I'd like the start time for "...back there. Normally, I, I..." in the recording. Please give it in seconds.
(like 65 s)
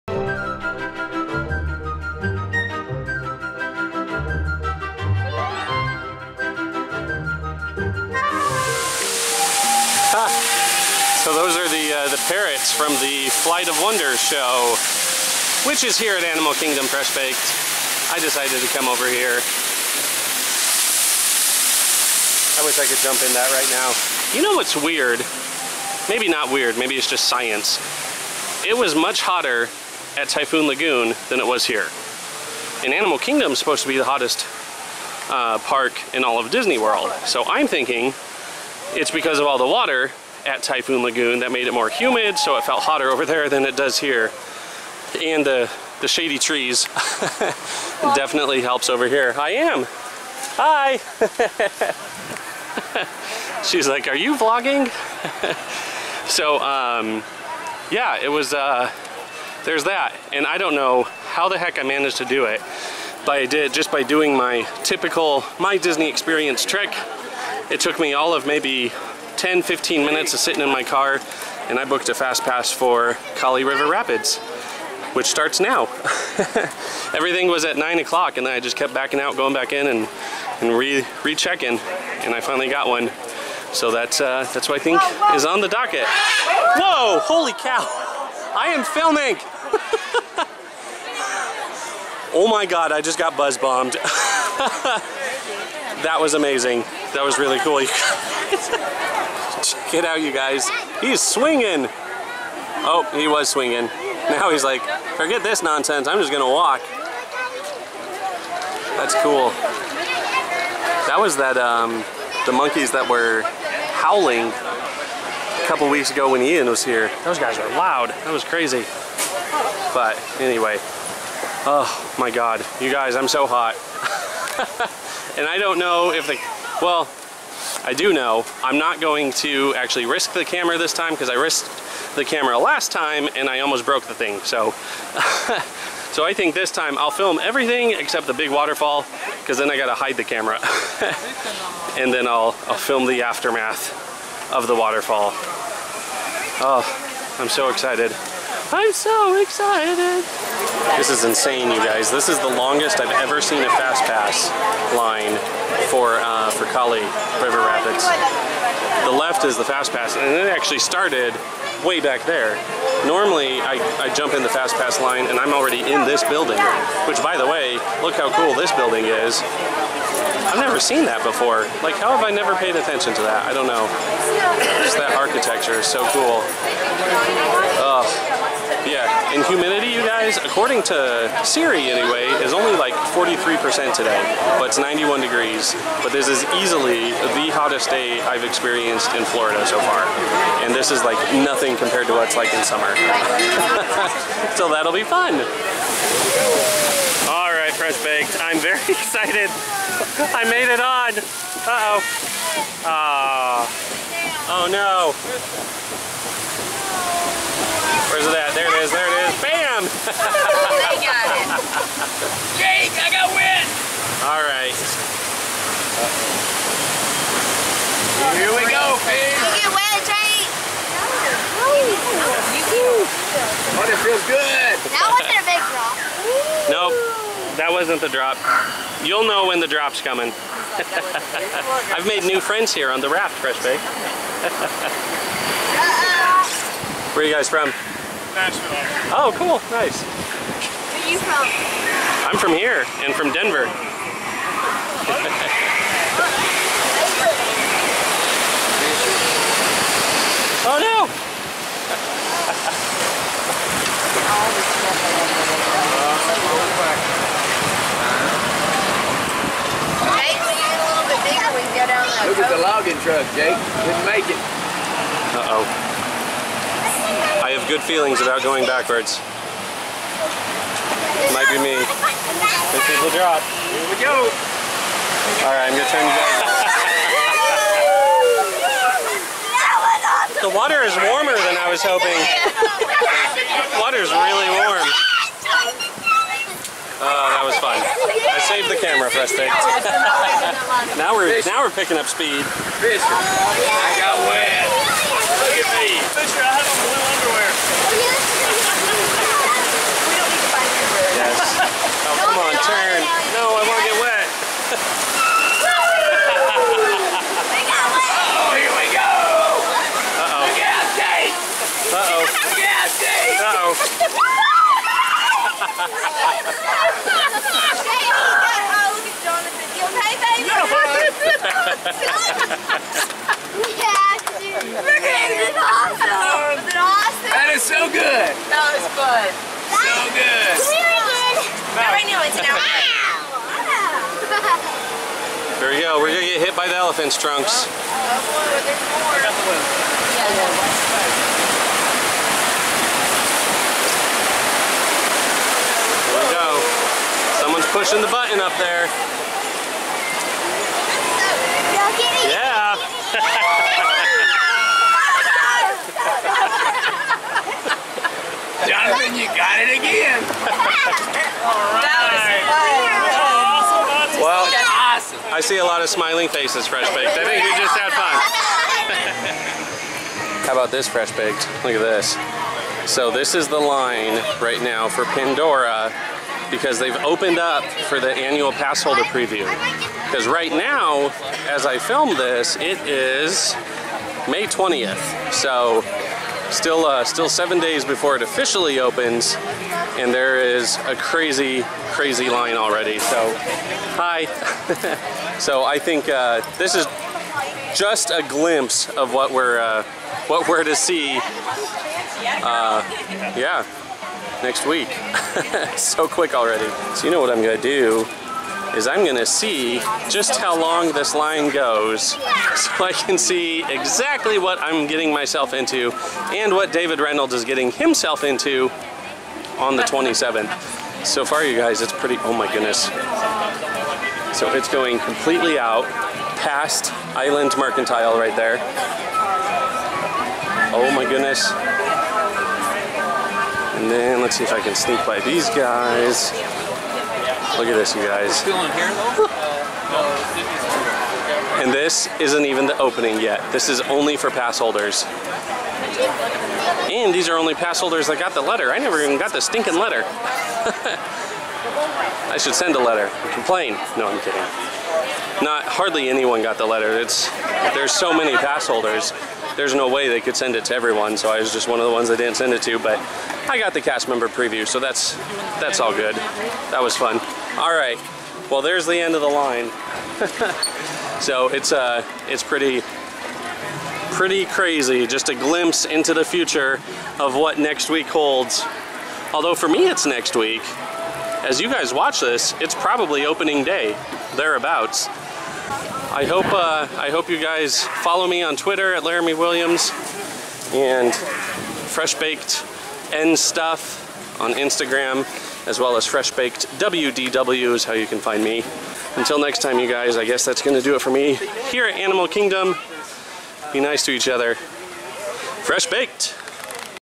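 161 s.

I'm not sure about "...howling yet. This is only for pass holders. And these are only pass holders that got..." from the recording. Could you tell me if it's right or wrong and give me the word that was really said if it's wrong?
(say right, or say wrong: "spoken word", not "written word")
wrong: "opening", not "howling".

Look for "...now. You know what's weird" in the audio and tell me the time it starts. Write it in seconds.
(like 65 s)
23 s.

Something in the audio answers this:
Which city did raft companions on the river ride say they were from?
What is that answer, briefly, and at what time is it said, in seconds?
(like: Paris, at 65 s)
Nashville, at 238 s.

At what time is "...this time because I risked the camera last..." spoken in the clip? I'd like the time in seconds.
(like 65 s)
130 s.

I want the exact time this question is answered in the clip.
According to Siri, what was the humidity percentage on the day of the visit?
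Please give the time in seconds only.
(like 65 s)
183 s.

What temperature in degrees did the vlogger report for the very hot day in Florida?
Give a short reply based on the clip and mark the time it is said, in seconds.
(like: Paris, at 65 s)
91 degrees, at 184 s.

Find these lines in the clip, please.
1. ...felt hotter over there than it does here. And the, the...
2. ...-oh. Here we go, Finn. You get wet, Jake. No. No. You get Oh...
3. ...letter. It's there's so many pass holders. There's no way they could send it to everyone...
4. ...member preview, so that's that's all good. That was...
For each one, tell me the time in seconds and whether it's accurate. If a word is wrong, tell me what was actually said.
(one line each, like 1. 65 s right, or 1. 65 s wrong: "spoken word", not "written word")
1. 42 s right
2. 218 s right
3. 456 s right
4. 464 s right.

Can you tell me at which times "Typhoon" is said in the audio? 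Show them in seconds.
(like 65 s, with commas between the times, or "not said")
30 s, 40 s.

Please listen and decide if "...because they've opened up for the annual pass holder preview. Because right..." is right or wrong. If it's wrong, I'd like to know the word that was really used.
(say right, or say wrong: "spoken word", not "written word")
right.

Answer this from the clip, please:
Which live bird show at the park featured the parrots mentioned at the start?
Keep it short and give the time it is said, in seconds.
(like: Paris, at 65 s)
Flight of Wonder, at 13 s.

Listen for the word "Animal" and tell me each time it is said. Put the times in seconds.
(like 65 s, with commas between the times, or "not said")
16 s, 32 s, 501 s.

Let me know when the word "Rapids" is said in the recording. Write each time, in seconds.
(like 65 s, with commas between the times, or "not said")
73 s, 157 s.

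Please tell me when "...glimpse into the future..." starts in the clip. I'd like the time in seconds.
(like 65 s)
475 s.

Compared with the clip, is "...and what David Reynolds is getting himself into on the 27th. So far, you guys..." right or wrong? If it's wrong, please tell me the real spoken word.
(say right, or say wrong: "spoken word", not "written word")
right.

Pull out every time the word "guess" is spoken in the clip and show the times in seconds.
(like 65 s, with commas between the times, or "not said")
500 s.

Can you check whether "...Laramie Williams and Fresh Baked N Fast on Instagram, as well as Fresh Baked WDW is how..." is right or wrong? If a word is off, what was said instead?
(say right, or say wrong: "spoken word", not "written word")
wrong: "Stuff", not "Fast".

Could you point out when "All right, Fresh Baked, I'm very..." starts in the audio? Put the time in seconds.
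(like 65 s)
197 s.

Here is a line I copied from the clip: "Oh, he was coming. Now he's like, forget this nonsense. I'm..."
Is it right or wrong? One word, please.
wrong.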